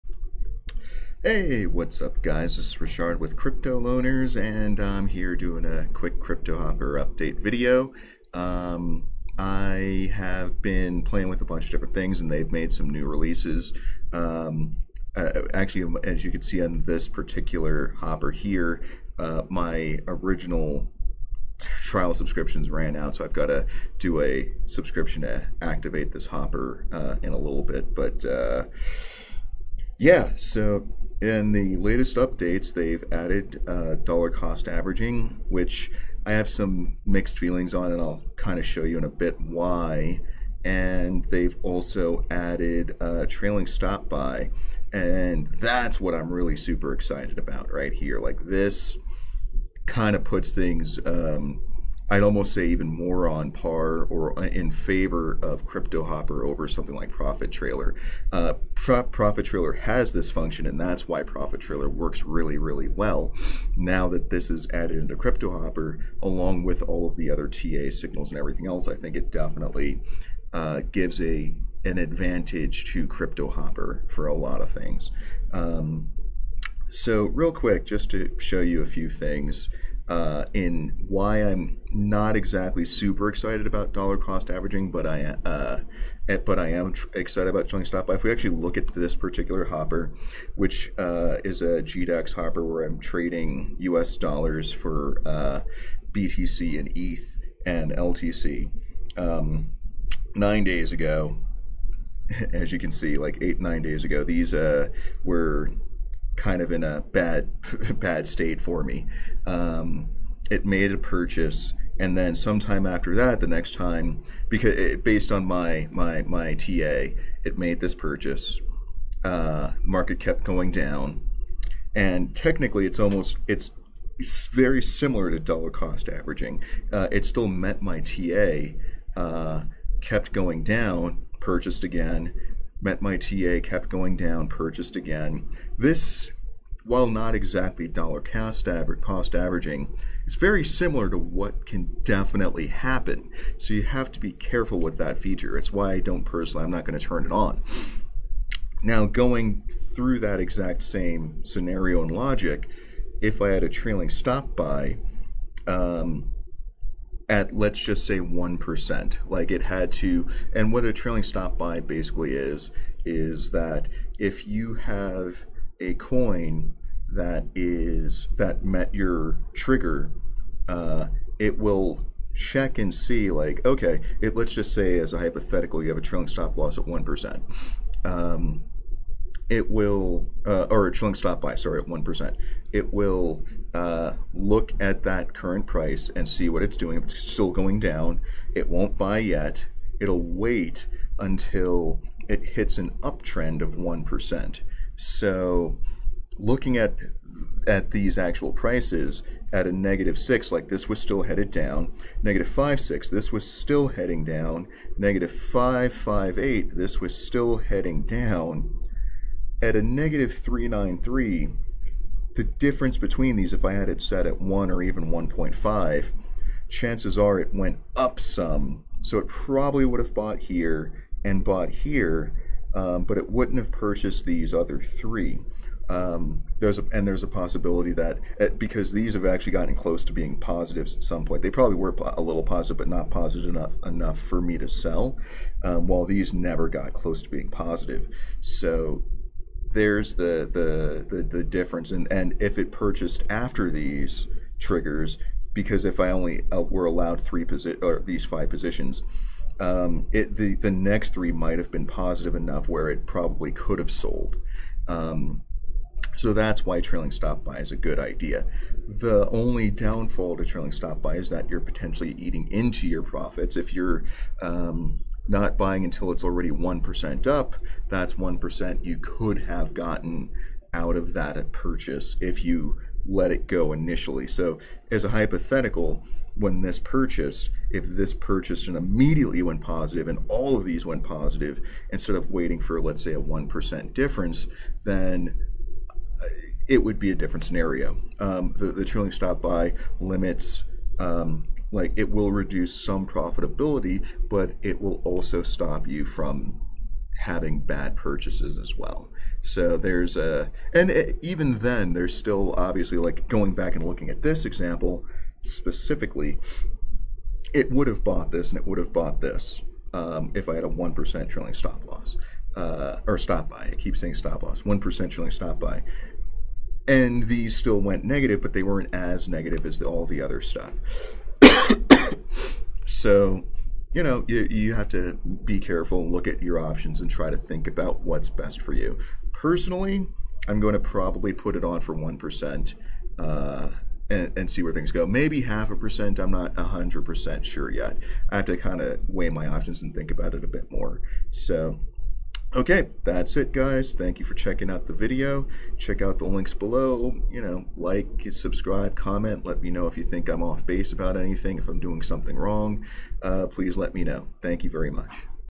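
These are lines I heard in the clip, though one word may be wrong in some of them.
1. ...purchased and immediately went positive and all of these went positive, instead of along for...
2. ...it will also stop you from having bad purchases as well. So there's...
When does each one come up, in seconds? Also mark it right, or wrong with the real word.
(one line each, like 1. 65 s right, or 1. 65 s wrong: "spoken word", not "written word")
1. 278 s wrong: "waiting", not "along"
2. 294 s right.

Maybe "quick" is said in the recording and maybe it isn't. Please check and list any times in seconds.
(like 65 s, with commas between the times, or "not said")
5 s, 77 s.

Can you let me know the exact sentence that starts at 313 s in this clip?
I keep saying stop loss, 1% trailing stop buy.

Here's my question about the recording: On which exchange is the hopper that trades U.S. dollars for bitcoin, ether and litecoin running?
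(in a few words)
GDAX.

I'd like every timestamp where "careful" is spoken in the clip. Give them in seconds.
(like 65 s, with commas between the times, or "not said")
144 s, 325 s.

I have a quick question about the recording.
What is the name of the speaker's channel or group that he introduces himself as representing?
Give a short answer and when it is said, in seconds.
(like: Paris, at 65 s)
Crypto Loaners, at 3 s.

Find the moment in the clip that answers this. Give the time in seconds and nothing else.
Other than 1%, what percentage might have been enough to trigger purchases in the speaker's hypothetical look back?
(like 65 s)
215 s.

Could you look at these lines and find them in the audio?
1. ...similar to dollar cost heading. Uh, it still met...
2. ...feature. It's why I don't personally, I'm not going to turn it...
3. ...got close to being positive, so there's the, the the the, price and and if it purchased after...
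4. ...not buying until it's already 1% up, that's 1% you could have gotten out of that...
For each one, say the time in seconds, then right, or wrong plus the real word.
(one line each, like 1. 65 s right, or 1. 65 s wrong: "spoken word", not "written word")
1. 124 s wrong: "averaging", not "heading"
2. 145 s right
3. 236 s wrong: "difference", not "price"
4. 265 s right.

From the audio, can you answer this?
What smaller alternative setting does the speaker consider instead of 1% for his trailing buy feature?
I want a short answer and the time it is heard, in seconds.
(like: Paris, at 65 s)
half a percent, at 335 s.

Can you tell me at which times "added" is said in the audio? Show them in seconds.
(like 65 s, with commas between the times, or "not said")
33 s, 42 s, 64 s.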